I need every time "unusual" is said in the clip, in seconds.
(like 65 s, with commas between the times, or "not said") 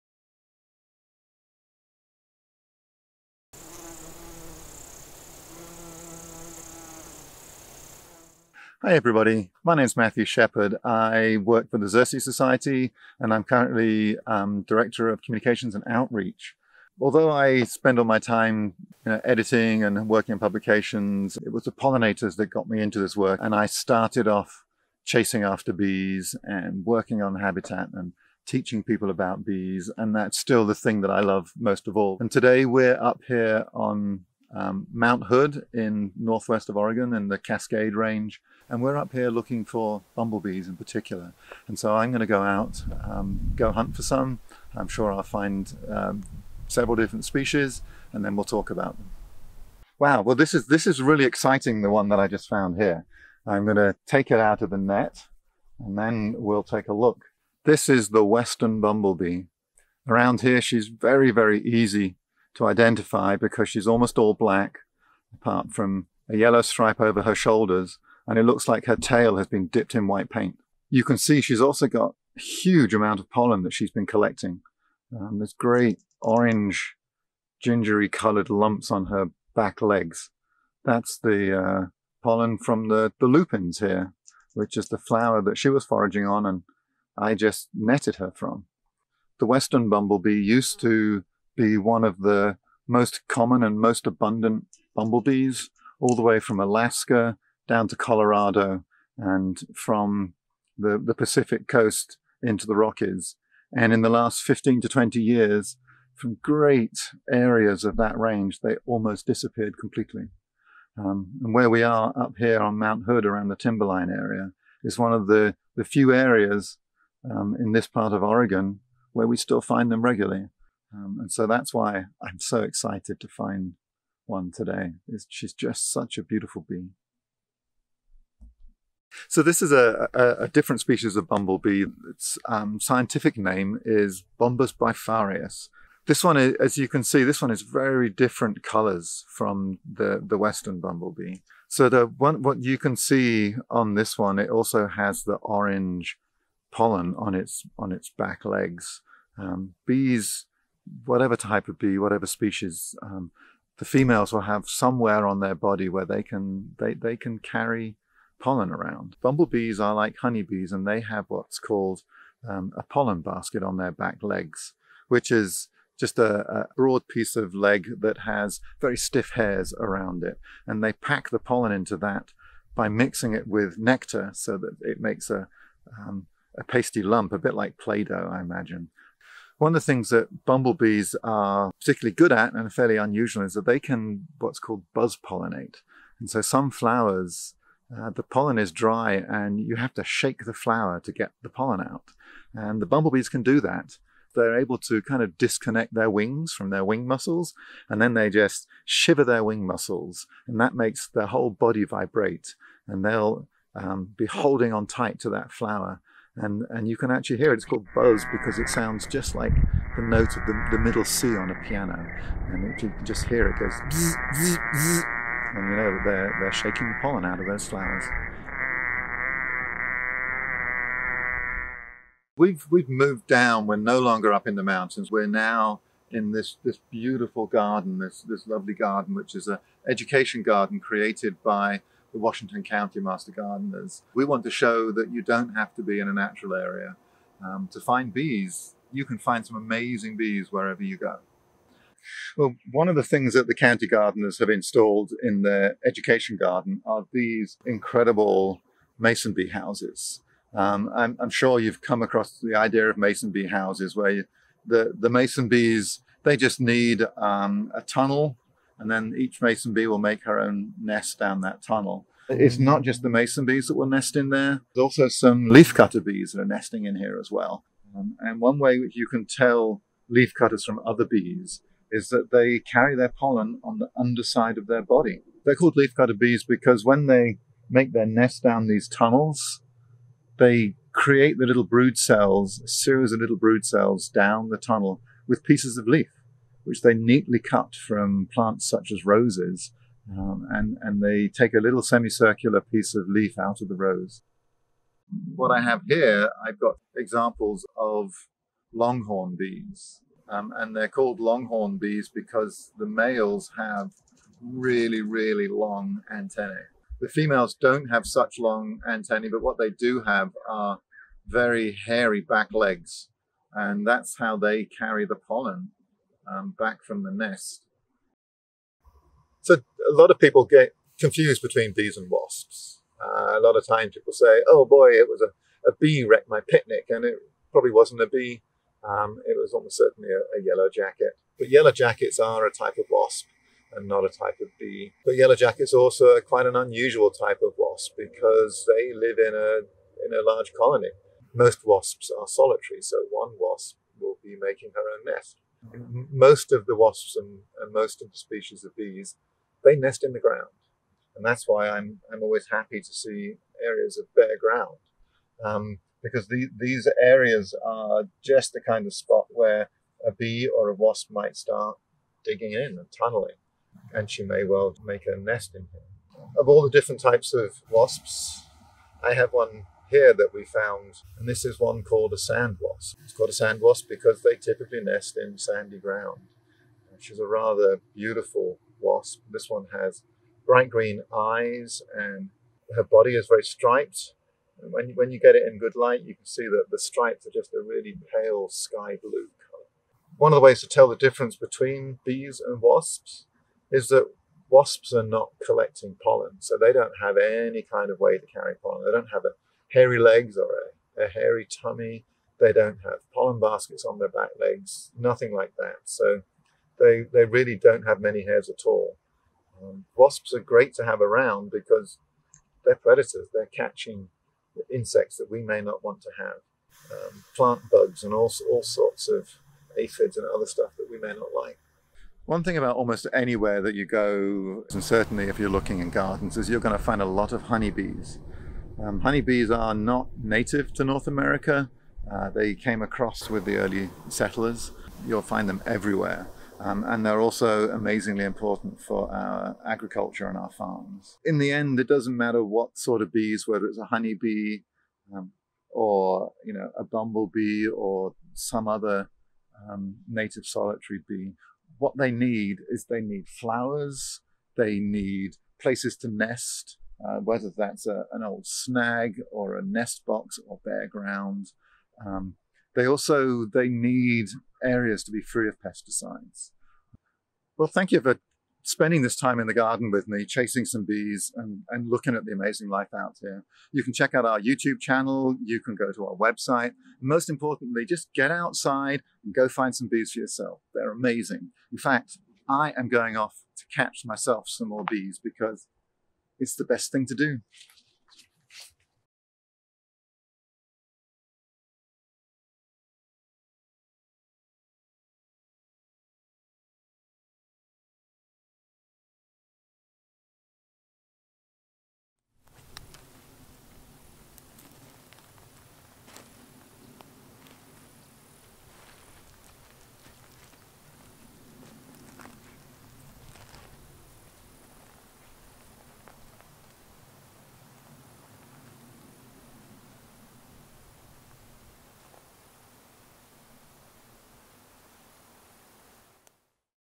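182 s, 336 s.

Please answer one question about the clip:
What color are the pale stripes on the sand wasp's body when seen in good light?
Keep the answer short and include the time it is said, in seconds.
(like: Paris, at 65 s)
Pale sky blue, at 388 s.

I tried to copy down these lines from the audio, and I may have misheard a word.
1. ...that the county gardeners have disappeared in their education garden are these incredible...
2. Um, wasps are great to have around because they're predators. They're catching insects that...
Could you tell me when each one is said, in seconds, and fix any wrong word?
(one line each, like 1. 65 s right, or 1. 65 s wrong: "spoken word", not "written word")
1. 243 s wrong: "installed", not "disappeared"
2. 409 s right.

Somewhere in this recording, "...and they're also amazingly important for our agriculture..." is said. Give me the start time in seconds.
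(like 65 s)
436 s.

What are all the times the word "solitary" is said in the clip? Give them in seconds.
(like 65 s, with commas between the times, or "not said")
342 s, 450 s.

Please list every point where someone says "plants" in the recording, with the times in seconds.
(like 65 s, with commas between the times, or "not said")
288 s, 417 s.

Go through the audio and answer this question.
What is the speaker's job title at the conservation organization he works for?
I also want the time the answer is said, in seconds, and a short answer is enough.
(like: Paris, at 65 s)
Director of Communications and Outreach, at 14 s.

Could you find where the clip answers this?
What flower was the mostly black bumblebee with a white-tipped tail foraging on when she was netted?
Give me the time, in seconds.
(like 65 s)
83 s.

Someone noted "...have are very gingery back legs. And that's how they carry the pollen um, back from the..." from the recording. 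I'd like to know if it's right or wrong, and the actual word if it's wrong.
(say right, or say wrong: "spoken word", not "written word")
wrong: "hairy", not "gingery".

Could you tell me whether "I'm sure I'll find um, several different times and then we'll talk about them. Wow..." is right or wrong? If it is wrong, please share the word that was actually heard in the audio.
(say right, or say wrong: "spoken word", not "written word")
wrong: "species", not "times".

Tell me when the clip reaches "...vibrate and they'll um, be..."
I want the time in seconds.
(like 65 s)
201 s.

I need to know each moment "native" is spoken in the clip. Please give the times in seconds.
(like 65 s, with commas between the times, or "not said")
430 s, 450 s.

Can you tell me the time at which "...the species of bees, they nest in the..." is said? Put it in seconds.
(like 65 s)
348 s.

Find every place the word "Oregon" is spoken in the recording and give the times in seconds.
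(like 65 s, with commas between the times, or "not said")
36 s, 118 s.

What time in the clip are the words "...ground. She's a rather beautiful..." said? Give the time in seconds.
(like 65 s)
375 s.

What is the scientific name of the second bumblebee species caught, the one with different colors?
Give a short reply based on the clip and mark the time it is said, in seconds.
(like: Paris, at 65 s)
Bombus bifarius, at 134 s.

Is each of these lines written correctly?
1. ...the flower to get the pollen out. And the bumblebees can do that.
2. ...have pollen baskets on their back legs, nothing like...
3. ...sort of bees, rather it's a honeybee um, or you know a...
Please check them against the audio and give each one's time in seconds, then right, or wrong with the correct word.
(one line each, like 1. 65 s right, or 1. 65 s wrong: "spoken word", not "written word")
1. 190 s right
2. 402 s right
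3. 442 s wrong: "whether", not "rather".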